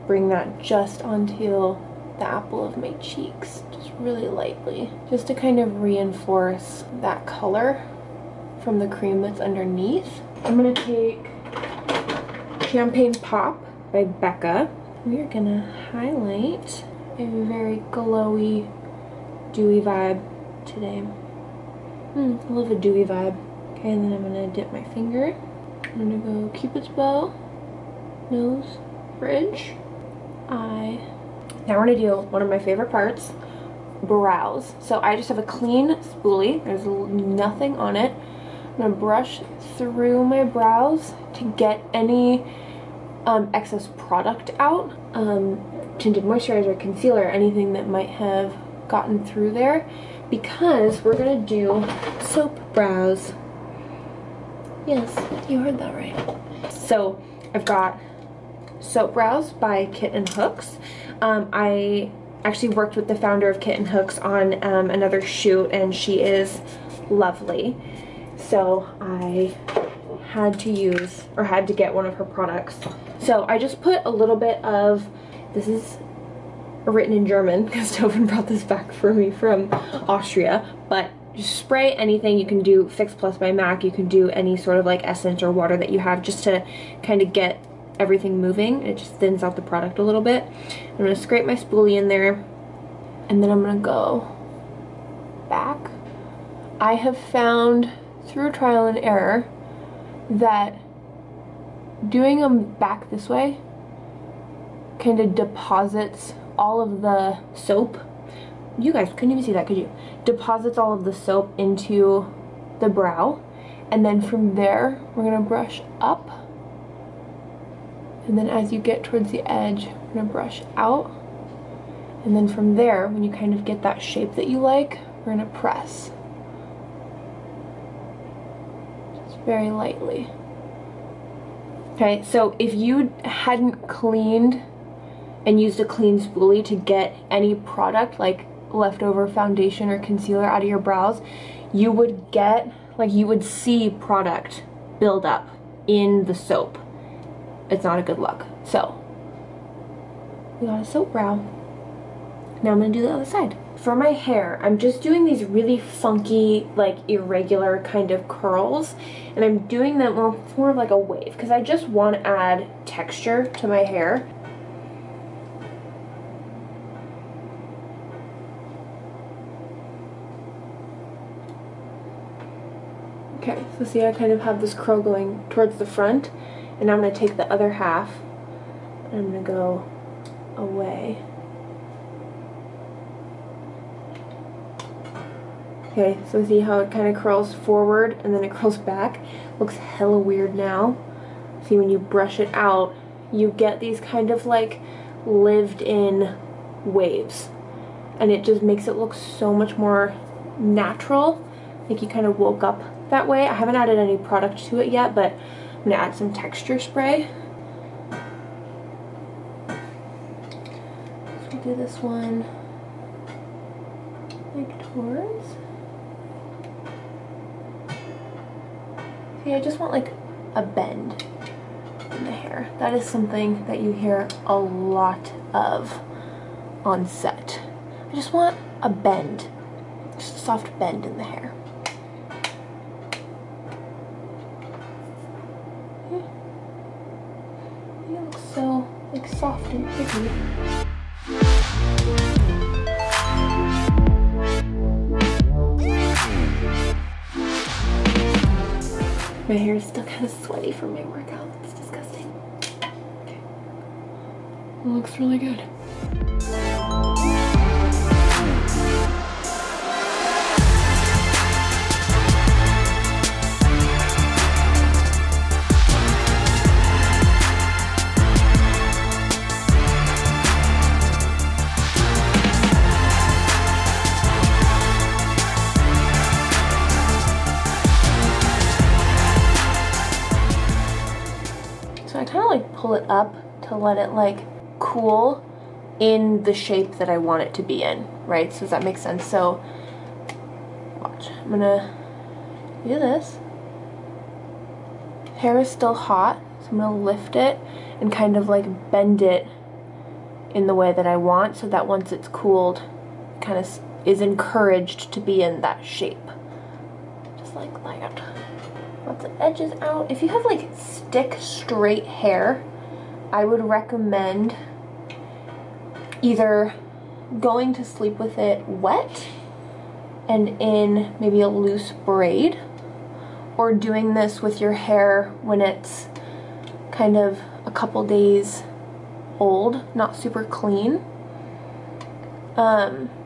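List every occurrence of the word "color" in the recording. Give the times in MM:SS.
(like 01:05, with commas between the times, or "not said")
00:07.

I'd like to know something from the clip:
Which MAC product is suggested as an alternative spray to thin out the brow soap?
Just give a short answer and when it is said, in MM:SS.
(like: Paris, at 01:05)
Fix Plus, at 01:22.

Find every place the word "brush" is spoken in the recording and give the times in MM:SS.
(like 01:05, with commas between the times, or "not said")
00:38, 01:55, 02:00, 03:11.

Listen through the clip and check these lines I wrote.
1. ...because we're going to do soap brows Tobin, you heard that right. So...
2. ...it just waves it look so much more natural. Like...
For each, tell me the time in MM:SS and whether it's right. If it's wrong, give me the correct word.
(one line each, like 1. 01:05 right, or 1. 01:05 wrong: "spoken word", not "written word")
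1. 00:50 wrong: "Yes", not "Tobin"
2. 03:18 wrong: "makes", not "waves".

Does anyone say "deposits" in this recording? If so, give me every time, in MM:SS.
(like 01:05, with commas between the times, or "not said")
01:45, 01:50.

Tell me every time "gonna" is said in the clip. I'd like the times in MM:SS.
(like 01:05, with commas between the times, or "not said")
00:10, 00:15, 01:55, 02:00, 02:05, 02:32, 04:51, 04:56.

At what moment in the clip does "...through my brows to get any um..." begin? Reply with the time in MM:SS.
00:39.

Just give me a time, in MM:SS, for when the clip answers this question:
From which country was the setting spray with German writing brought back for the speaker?
01:20.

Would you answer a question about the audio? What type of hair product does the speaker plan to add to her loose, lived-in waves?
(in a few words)
texture spray.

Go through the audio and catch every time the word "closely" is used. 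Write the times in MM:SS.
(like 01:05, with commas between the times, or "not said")
not said.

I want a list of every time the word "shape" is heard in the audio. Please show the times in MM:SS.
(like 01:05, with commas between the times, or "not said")
02:04, 04:46, 05:05.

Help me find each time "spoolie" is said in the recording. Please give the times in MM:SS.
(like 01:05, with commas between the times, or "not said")
00:35, 01:31, 02:16.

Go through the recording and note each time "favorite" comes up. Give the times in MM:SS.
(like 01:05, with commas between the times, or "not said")
00:32.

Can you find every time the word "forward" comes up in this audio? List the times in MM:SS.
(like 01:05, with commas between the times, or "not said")
03:07.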